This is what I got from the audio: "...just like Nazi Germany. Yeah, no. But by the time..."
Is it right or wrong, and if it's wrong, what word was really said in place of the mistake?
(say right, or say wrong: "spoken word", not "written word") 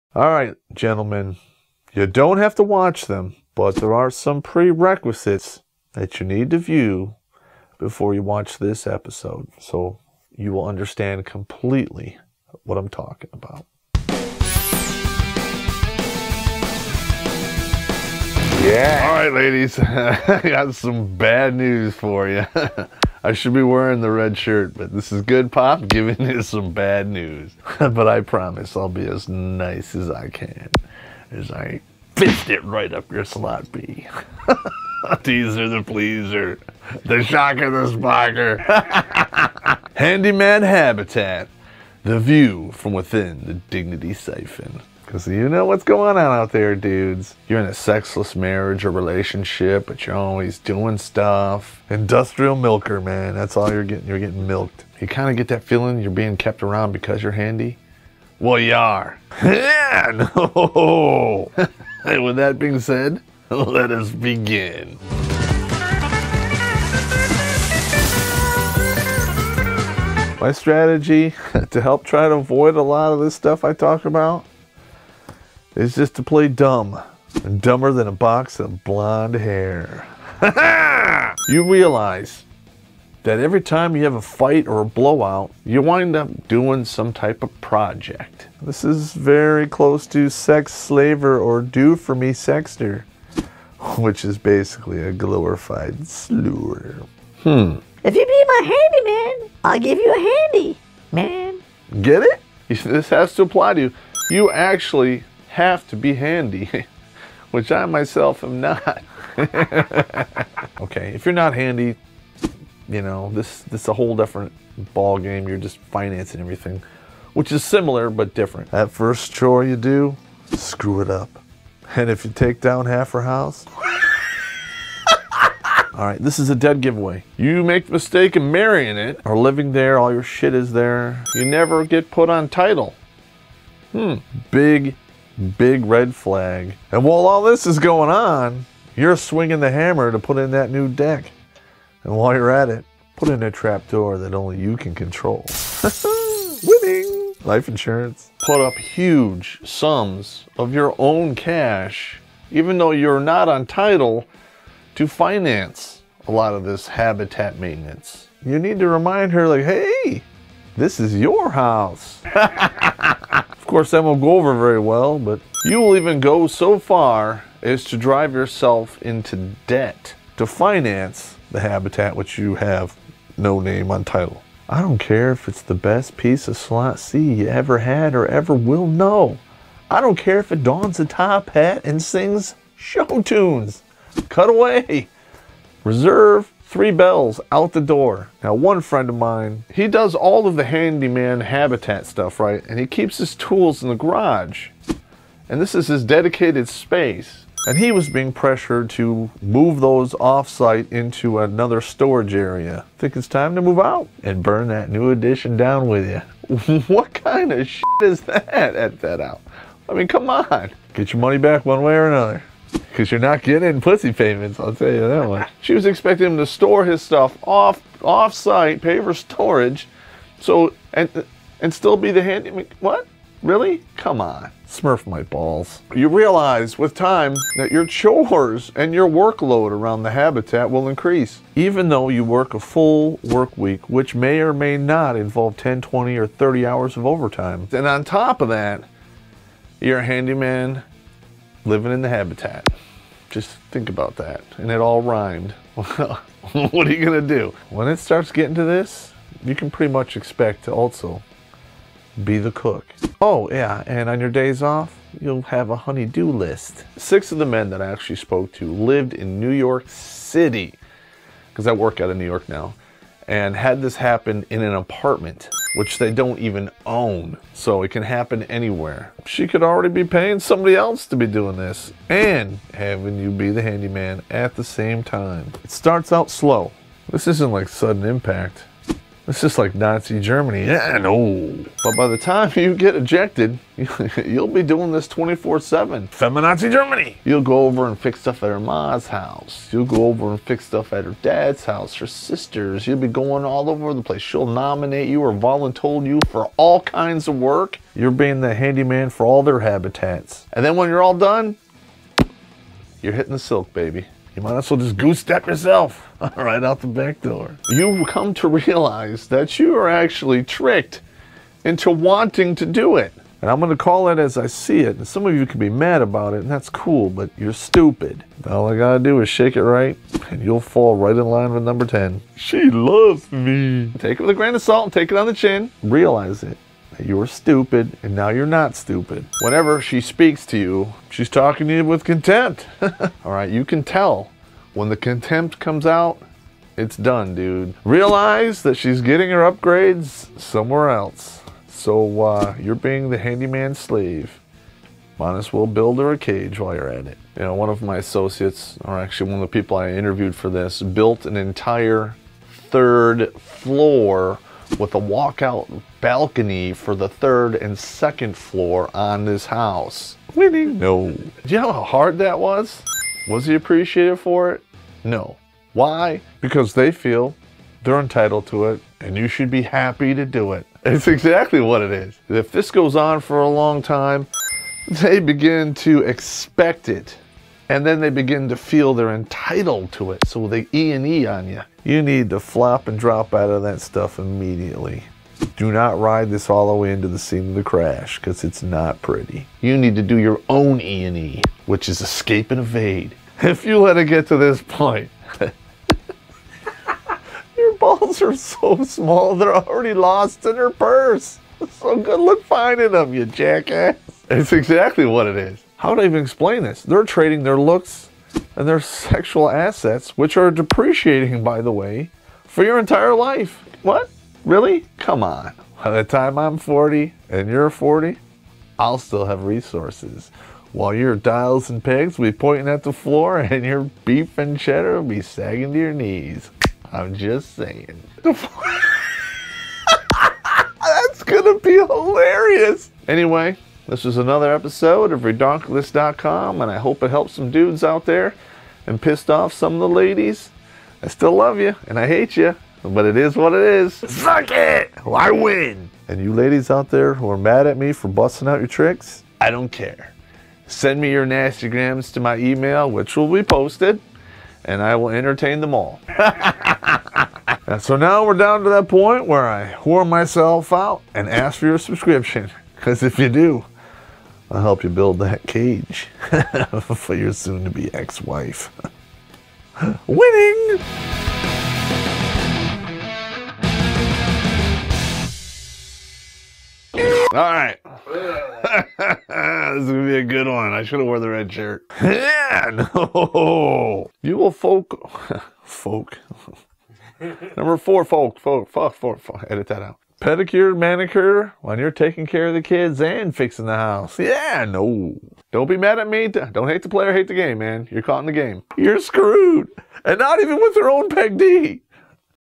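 right.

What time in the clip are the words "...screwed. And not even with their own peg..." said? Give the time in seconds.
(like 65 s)
498 s.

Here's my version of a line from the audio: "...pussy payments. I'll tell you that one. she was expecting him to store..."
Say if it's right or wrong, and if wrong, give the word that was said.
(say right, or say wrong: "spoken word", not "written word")
right.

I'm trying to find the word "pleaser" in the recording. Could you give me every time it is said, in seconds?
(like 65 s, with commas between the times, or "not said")
35 s.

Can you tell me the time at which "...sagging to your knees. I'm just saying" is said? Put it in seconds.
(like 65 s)
425 s.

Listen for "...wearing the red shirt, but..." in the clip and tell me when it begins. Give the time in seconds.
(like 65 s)
23 s.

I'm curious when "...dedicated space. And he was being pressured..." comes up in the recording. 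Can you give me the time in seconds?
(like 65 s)
196 s.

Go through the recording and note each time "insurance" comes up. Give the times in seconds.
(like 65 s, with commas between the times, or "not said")
147 s.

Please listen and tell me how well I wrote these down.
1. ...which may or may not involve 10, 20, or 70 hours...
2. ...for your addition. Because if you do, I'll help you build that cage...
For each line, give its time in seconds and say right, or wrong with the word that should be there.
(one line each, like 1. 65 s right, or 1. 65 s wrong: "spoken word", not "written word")
1. 233 s wrong: "30", not "70"
2. 461 s wrong: "subscription", not "addition".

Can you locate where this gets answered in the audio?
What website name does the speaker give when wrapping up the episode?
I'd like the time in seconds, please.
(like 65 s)
435 s.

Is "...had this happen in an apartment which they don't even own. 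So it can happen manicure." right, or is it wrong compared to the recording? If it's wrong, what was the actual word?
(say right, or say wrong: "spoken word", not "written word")
wrong: "anywhere", not "manicure".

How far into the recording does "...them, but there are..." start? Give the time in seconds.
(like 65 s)
3 s.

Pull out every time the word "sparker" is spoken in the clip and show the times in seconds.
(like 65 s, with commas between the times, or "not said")
37 s.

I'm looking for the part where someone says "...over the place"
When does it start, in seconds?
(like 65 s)
293 s.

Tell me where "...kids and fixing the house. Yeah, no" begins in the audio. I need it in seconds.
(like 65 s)
492 s.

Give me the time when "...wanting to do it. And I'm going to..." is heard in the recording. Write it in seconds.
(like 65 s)
311 s.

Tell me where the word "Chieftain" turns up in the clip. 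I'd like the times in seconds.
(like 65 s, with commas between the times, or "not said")
not said.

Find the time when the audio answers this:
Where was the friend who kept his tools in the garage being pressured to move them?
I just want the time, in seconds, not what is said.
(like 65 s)
201 s.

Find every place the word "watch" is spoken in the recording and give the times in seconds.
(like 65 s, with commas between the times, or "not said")
2 s, 8 s.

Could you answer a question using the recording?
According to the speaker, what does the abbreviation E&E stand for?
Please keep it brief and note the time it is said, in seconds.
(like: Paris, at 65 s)
Escape and evade, at 392 s.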